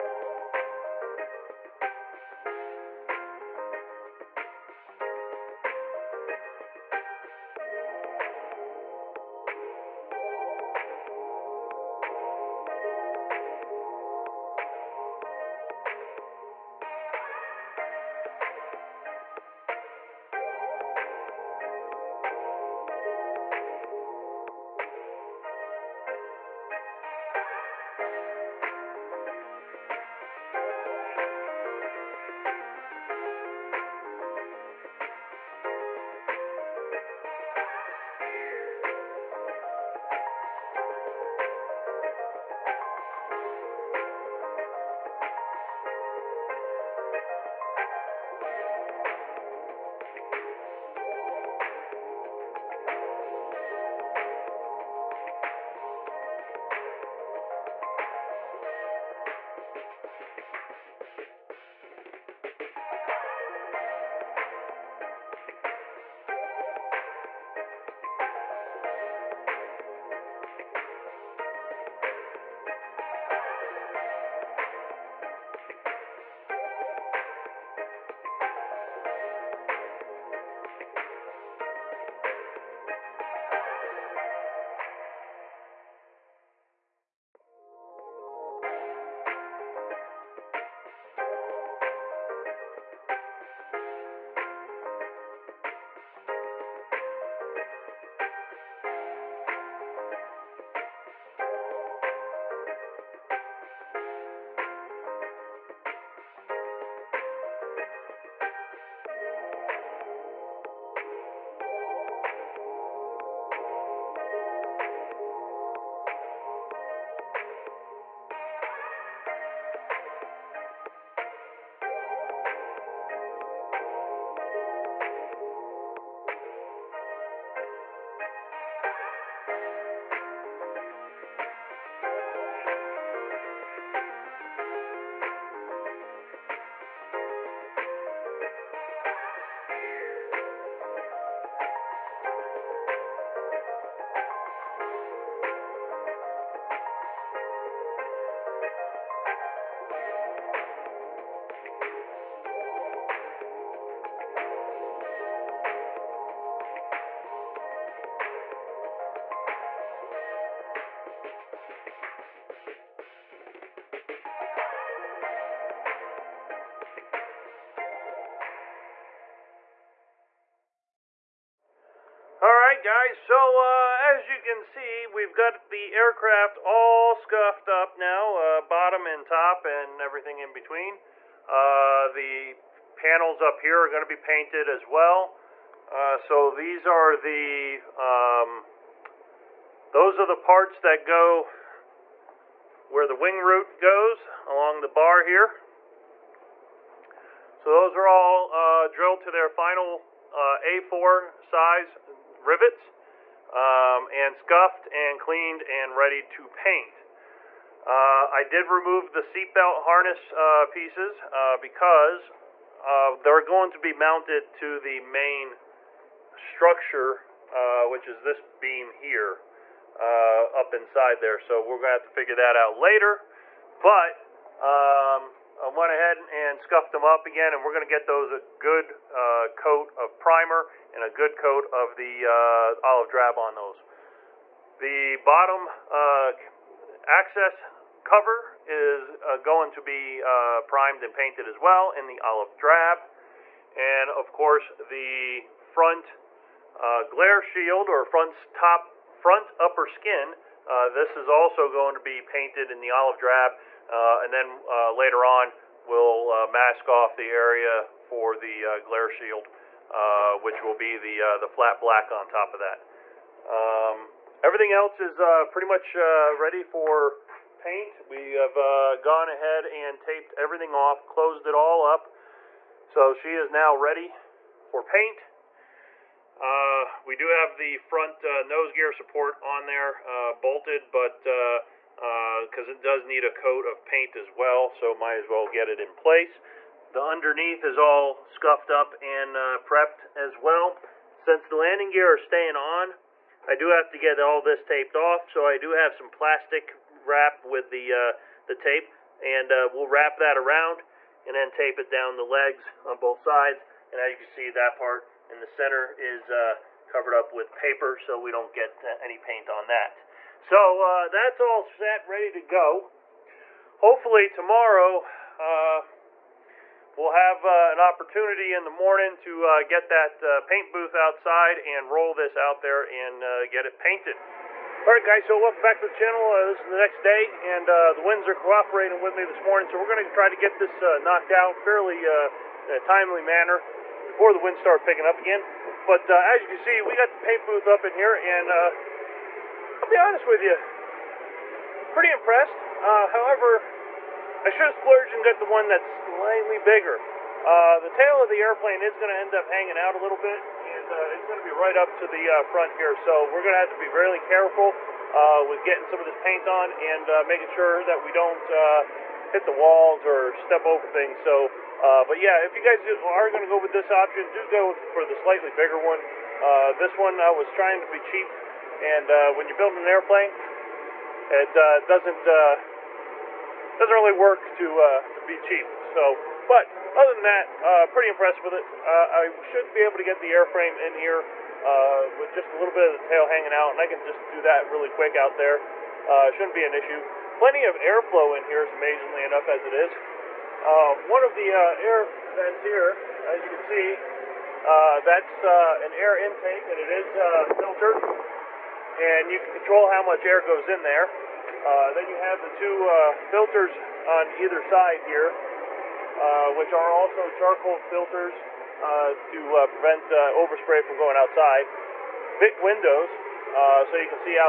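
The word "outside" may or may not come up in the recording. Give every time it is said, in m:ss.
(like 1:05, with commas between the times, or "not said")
5:20, 6:51.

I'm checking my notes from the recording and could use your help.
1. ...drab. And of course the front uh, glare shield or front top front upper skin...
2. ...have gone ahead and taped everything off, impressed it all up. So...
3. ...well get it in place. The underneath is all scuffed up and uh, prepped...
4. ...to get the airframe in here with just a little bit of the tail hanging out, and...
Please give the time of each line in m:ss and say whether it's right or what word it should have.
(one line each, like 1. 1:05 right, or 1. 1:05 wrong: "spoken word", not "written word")
1. 4:02 right
2. 4:28 wrong: "closed", not "impressed"
3. 4:45 right
4. 6:19 right.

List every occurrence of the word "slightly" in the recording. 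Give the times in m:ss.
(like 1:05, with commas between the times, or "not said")
5:45, 6:05.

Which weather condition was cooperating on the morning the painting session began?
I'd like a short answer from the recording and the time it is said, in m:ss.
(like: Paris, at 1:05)
the winds, at 5:28.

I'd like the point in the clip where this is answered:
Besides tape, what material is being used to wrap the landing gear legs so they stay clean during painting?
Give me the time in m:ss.
4:56.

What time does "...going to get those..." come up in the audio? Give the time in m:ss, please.
3:47.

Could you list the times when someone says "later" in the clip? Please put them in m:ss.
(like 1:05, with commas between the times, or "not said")
3:42, 4:14.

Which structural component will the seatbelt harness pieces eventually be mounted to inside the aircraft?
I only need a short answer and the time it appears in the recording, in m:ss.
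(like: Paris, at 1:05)
this beam, at 3:38.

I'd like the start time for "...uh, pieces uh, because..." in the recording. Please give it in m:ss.
3:30.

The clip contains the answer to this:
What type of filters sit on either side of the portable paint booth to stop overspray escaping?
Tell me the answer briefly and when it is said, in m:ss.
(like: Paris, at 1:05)
charcoal filters, at 6:47.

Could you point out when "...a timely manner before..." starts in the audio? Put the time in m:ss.
5:32.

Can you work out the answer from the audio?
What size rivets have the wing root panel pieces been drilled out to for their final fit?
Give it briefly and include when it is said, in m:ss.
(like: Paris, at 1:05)
A4, at 3:20.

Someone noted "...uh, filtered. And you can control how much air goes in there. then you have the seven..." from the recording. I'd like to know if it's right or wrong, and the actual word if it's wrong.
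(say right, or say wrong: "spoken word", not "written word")
wrong: "two", not "seven".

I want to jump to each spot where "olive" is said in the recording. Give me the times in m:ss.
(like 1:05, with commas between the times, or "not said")
3:52, 4:02, 4:12.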